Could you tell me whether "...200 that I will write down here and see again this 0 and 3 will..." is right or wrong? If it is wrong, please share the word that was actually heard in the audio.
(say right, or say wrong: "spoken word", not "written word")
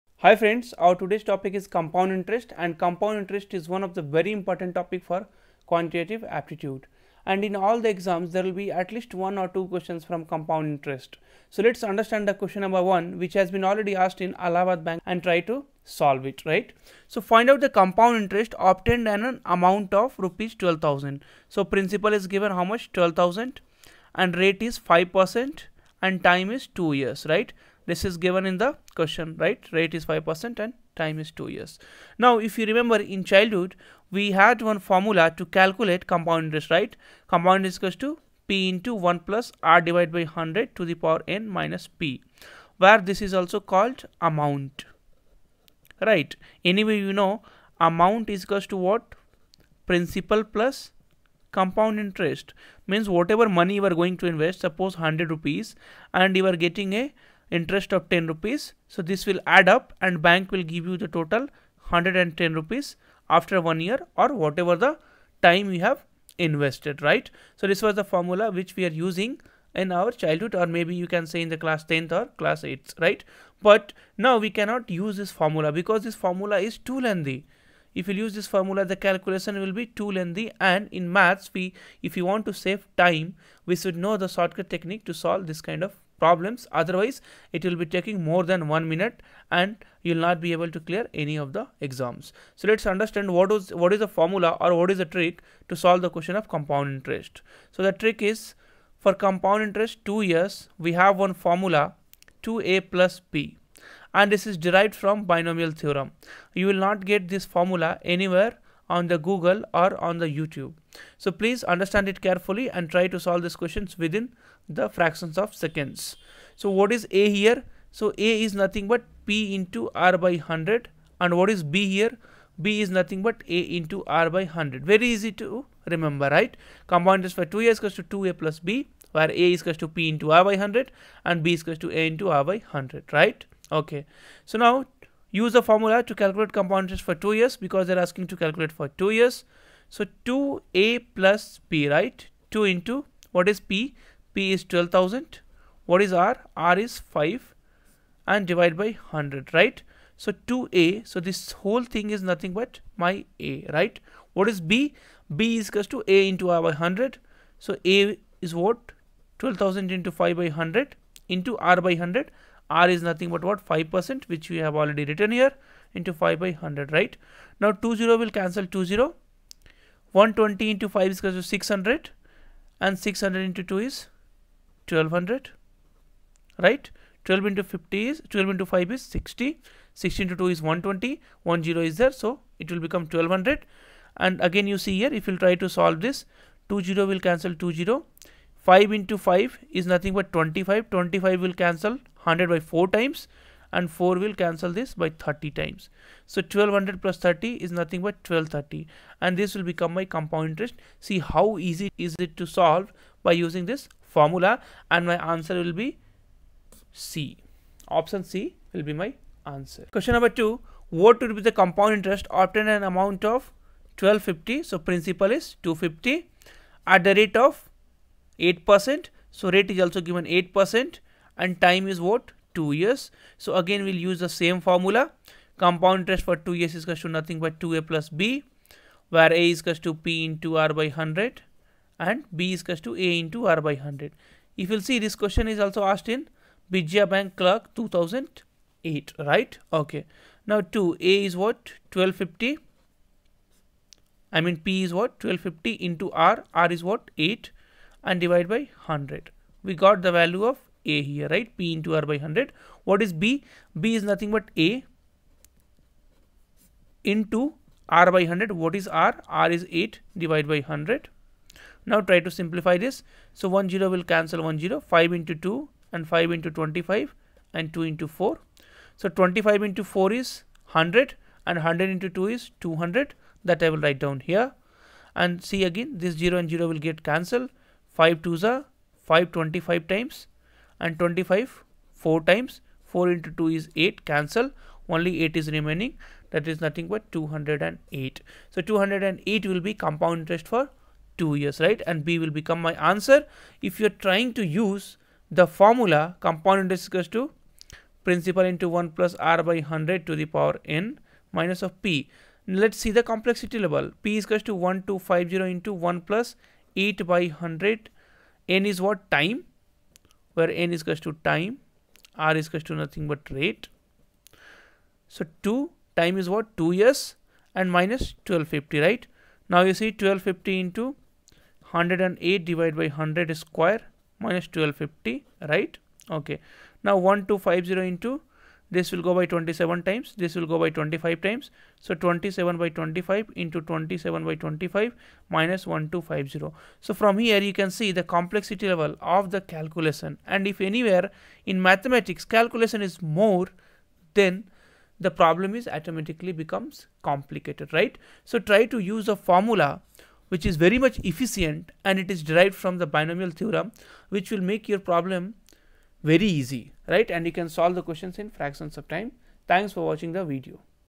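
wrong: "0", not "3".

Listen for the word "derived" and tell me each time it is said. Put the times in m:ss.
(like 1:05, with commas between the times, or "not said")
1:44, 5:52.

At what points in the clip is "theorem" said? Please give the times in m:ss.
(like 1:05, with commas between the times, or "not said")
1:45, 5:53.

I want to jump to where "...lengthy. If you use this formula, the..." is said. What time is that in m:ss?
1:16.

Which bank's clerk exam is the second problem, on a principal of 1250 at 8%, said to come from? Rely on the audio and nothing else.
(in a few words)
Vijaya Bank Clerk 2008.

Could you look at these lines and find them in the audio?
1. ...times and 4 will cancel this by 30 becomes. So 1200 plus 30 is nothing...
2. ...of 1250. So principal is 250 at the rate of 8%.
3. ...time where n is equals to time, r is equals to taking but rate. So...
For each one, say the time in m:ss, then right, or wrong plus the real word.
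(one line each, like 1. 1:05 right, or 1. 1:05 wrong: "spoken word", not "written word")
1. 3:12 wrong: "times", not "becomes"
2. 3:33 right
3. 5:09 wrong: "nothing", not "taking".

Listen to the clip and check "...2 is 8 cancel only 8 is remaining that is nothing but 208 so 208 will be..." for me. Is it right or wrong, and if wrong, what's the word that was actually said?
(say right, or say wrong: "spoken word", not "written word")
right.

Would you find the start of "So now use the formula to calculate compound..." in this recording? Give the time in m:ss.
2:14.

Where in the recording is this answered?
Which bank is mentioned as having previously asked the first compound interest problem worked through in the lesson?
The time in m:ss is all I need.
0:14.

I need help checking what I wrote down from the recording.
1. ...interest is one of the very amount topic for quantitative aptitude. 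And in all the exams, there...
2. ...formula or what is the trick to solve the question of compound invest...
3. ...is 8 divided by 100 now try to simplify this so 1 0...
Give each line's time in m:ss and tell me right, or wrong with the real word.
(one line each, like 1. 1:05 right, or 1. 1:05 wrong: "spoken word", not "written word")
1. 0:03 wrong: "important", not "amount"
2. 1:34 wrong: "interest", not "invest"
3. 4:19 right.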